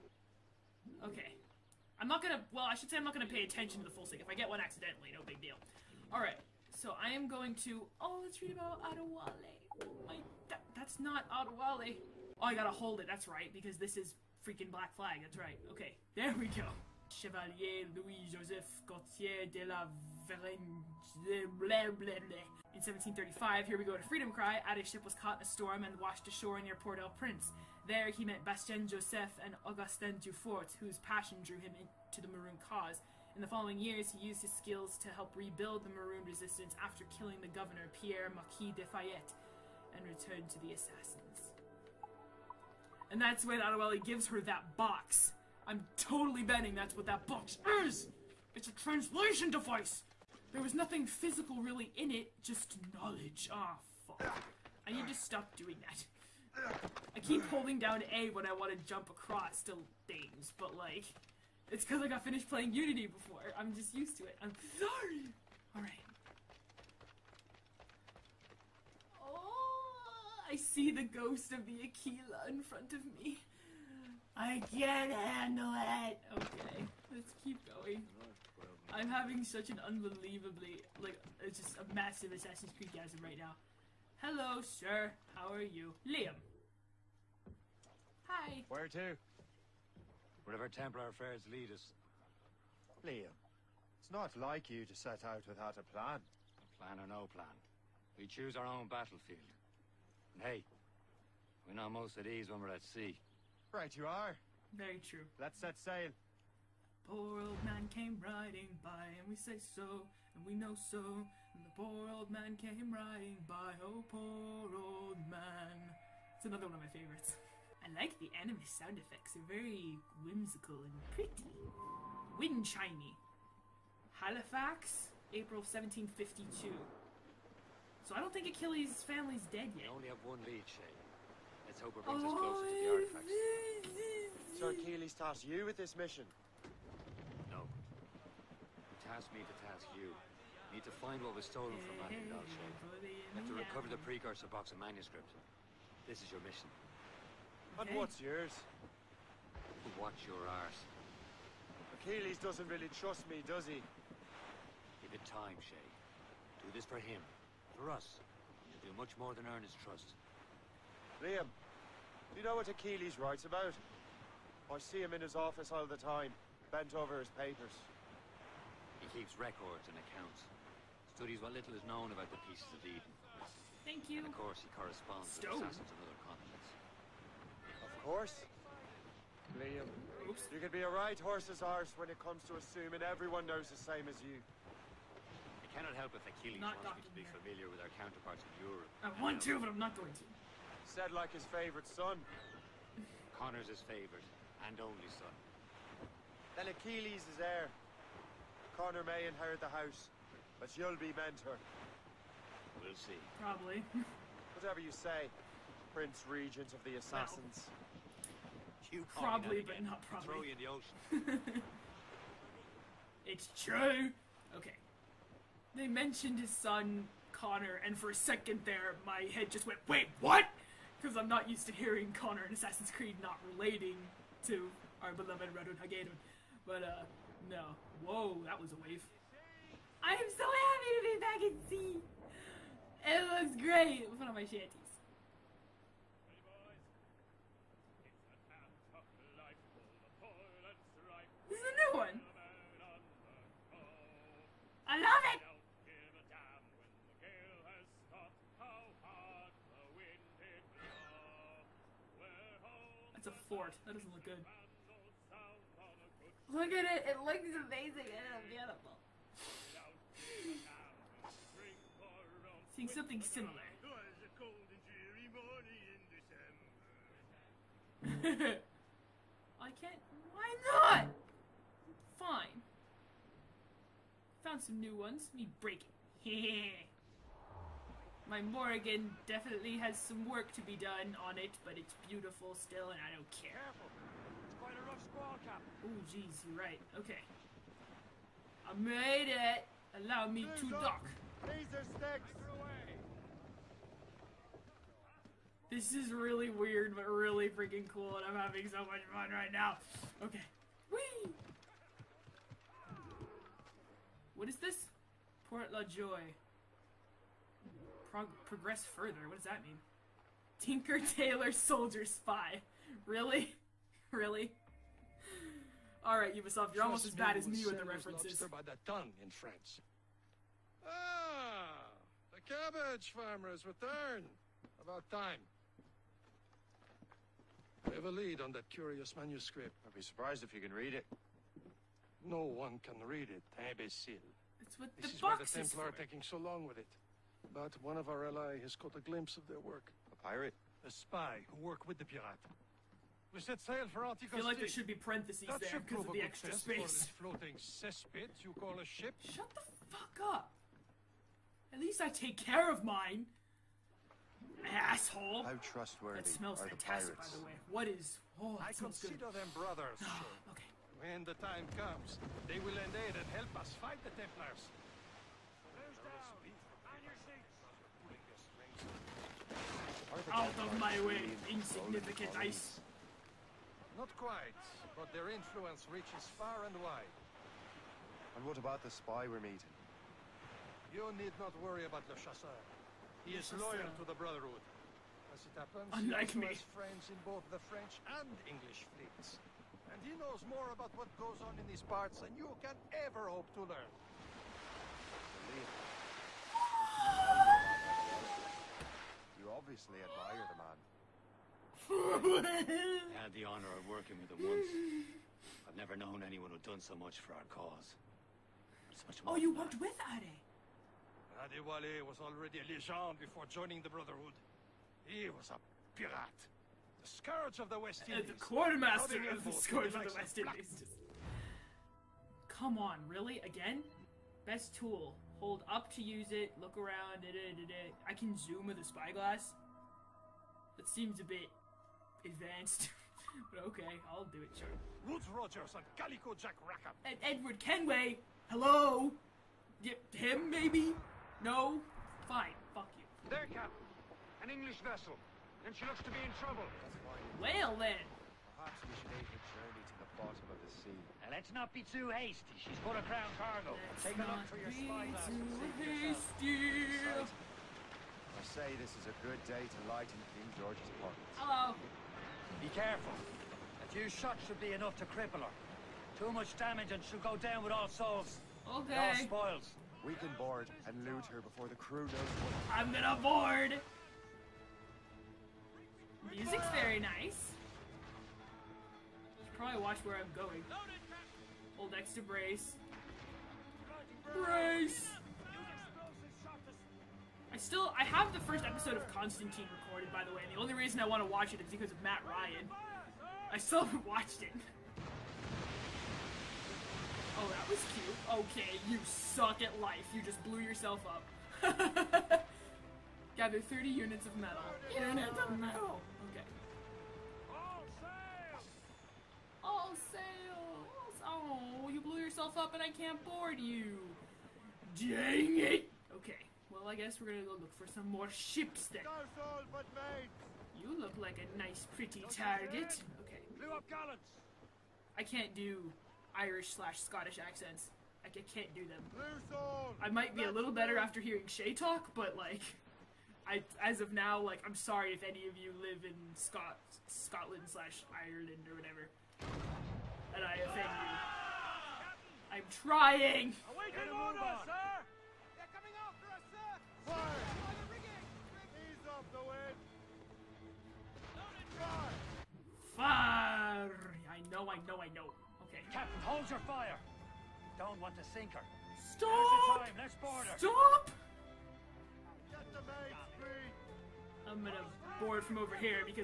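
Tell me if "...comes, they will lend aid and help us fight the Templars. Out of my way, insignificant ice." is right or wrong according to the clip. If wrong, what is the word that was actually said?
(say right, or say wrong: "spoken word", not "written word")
right.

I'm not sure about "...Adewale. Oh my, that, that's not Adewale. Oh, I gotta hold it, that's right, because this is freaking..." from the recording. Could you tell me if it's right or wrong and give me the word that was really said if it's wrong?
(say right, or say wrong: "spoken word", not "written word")
right.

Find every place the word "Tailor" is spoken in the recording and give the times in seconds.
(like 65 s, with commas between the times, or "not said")
311 s.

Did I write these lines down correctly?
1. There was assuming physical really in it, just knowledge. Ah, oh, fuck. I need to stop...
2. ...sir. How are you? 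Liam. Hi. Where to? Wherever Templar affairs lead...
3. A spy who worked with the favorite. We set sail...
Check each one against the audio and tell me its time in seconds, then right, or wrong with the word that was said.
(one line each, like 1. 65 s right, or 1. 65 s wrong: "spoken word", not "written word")
1. 50 s wrong: "nothing", not "assuming"
2. 84 s right
3. 340 s wrong: "pirate", not "favorite".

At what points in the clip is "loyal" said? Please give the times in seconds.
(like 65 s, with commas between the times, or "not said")
383 s.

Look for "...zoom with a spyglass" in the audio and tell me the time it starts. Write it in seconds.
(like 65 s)
428 s.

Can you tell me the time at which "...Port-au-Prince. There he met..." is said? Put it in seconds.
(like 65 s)
26 s.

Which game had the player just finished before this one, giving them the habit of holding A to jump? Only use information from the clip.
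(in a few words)
Unity.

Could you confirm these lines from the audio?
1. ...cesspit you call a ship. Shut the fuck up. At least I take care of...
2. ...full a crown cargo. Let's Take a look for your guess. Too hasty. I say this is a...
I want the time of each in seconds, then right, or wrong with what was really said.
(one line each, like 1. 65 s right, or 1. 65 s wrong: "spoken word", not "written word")
1. 347 s right
2. 452 s wrong: "spyglass", not "guess".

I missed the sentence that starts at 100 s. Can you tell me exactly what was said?
And hey, we're not most at ease when we're at sea.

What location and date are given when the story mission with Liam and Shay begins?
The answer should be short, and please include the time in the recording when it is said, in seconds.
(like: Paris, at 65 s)
Halifax, April 1752, at 124 s.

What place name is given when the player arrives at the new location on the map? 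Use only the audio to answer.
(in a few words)
Port La Joye.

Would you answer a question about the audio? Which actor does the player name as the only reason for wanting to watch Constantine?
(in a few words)
Matt Ryan.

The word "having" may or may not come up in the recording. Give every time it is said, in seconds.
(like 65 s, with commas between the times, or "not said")
79 s, 298 s.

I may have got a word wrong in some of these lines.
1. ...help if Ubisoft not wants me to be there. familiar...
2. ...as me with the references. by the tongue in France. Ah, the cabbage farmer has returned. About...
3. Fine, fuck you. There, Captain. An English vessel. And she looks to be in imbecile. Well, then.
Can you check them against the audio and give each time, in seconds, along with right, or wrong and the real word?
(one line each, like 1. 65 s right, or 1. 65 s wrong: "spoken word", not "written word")
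1. 185 s wrong: "Achilles", not "Ubisoft"
2. 317 s right
3. 442 s wrong: "trouble", not "imbecile".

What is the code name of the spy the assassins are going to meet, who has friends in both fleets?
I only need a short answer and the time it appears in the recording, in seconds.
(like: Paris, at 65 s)
Le Chasseur, at 382 s.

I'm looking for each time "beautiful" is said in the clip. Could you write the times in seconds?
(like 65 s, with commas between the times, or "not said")
258 s, 282 s.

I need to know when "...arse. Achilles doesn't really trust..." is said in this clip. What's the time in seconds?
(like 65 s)
150 s.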